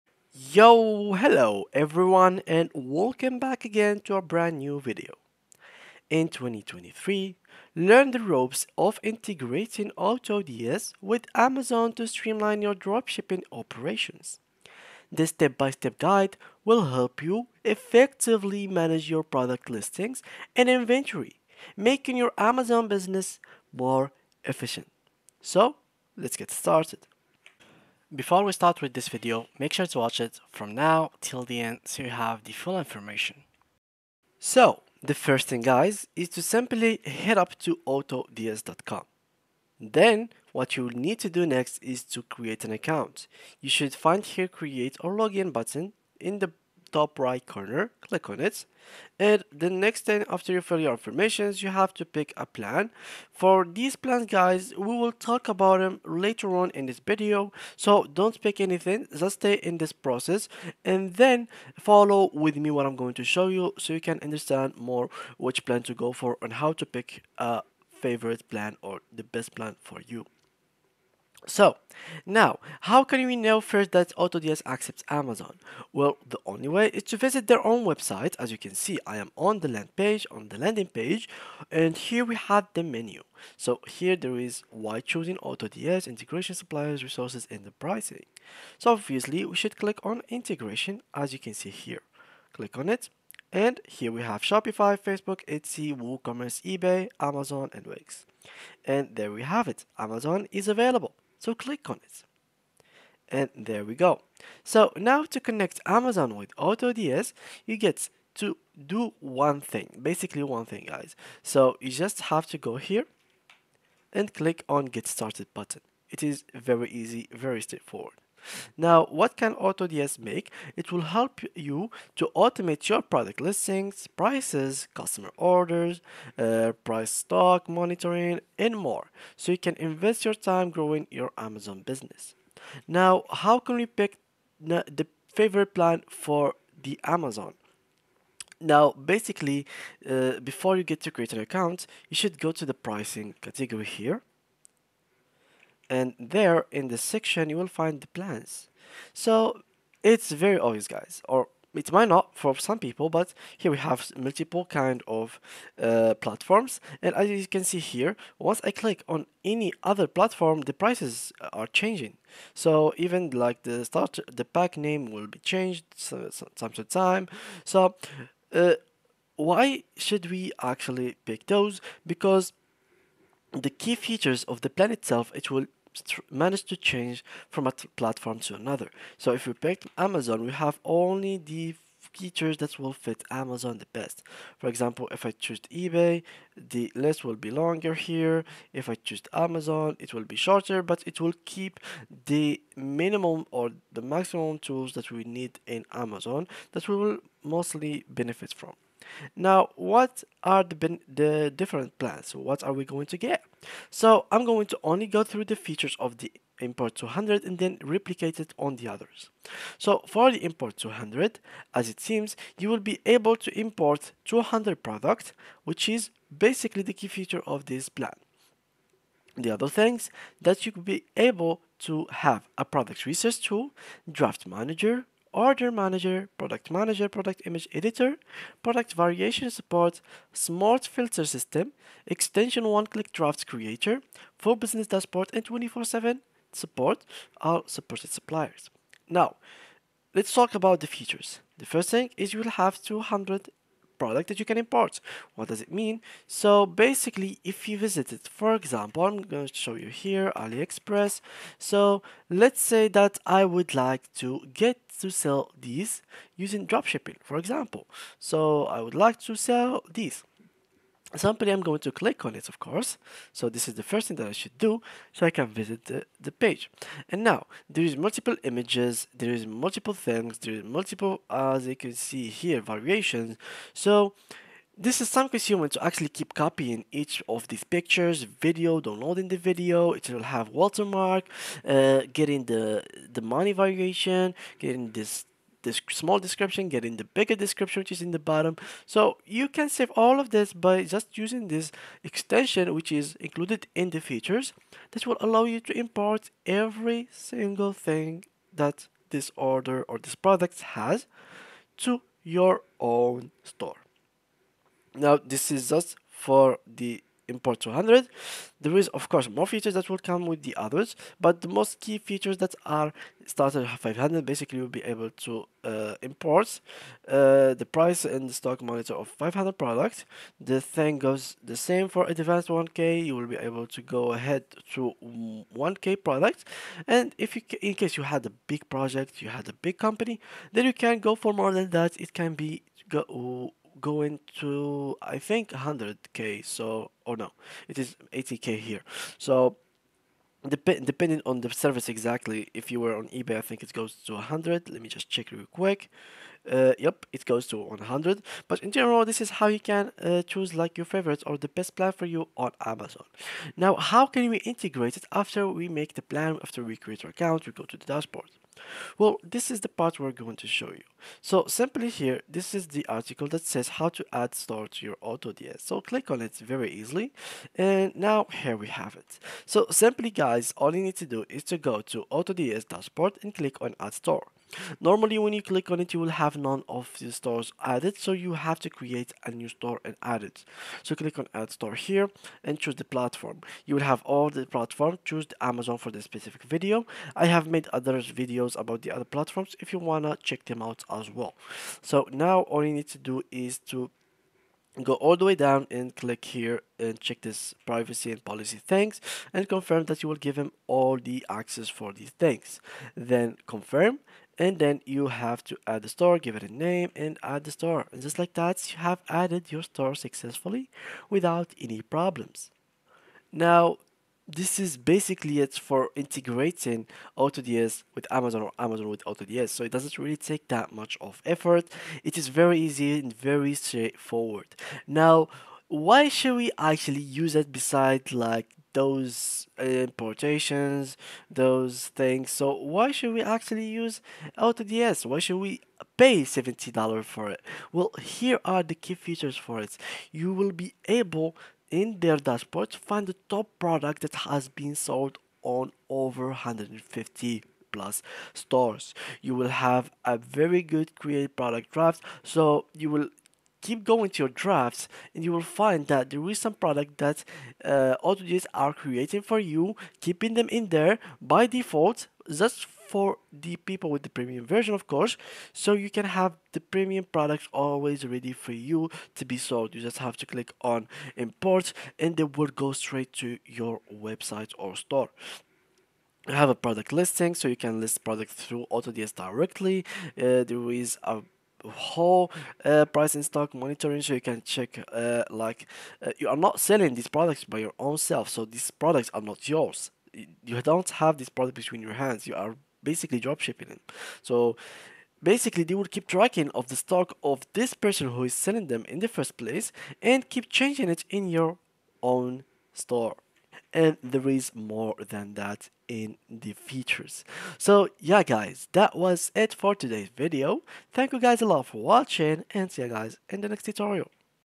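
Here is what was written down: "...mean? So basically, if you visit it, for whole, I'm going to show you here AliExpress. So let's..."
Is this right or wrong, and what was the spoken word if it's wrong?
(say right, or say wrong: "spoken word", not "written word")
wrong: "example", not "whole".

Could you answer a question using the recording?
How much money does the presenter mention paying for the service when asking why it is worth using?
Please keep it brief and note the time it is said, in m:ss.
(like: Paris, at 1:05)
$70, at 7:16.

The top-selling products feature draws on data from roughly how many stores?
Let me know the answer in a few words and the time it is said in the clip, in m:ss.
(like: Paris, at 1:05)
150 plus, at 7:26.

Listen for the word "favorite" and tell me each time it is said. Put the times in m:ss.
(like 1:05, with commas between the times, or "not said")
1:08, 2:15, 5:50.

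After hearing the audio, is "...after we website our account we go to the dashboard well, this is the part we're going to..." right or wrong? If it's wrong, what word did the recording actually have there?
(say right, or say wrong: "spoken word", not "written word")
wrong: "create", not "website".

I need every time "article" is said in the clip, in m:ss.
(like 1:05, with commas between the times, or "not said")
6:02.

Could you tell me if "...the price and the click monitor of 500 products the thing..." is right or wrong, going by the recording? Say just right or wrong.
wrong.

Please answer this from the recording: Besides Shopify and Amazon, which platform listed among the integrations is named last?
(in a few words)
Wix.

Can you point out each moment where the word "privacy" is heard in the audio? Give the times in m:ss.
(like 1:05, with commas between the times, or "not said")
6:37.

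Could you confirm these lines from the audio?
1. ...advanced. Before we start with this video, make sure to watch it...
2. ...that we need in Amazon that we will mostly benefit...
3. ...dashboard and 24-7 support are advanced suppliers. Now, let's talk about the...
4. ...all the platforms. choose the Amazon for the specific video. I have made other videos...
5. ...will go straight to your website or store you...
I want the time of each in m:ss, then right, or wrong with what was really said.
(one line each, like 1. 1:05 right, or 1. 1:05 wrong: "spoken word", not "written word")
1. 0:26 wrong: "started", not "advanced"
2. 3:14 right
3. 3:54 wrong: "supported", not "advanced"
4. 6:24 right
5. 7:52 right.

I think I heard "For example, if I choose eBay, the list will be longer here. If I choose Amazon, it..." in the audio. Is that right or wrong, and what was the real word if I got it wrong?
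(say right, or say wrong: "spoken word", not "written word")
right.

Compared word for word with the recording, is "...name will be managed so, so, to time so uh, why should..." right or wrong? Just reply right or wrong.
wrong.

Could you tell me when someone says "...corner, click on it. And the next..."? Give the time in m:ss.
0:47.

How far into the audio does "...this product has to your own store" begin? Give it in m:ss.
4:59.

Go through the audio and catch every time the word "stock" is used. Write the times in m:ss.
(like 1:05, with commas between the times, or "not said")
2:07, 5:18, 8:03, 8:16.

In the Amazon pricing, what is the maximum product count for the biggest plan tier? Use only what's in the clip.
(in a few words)
80k.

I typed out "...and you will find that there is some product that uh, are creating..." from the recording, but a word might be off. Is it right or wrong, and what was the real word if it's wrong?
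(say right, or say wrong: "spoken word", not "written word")
right.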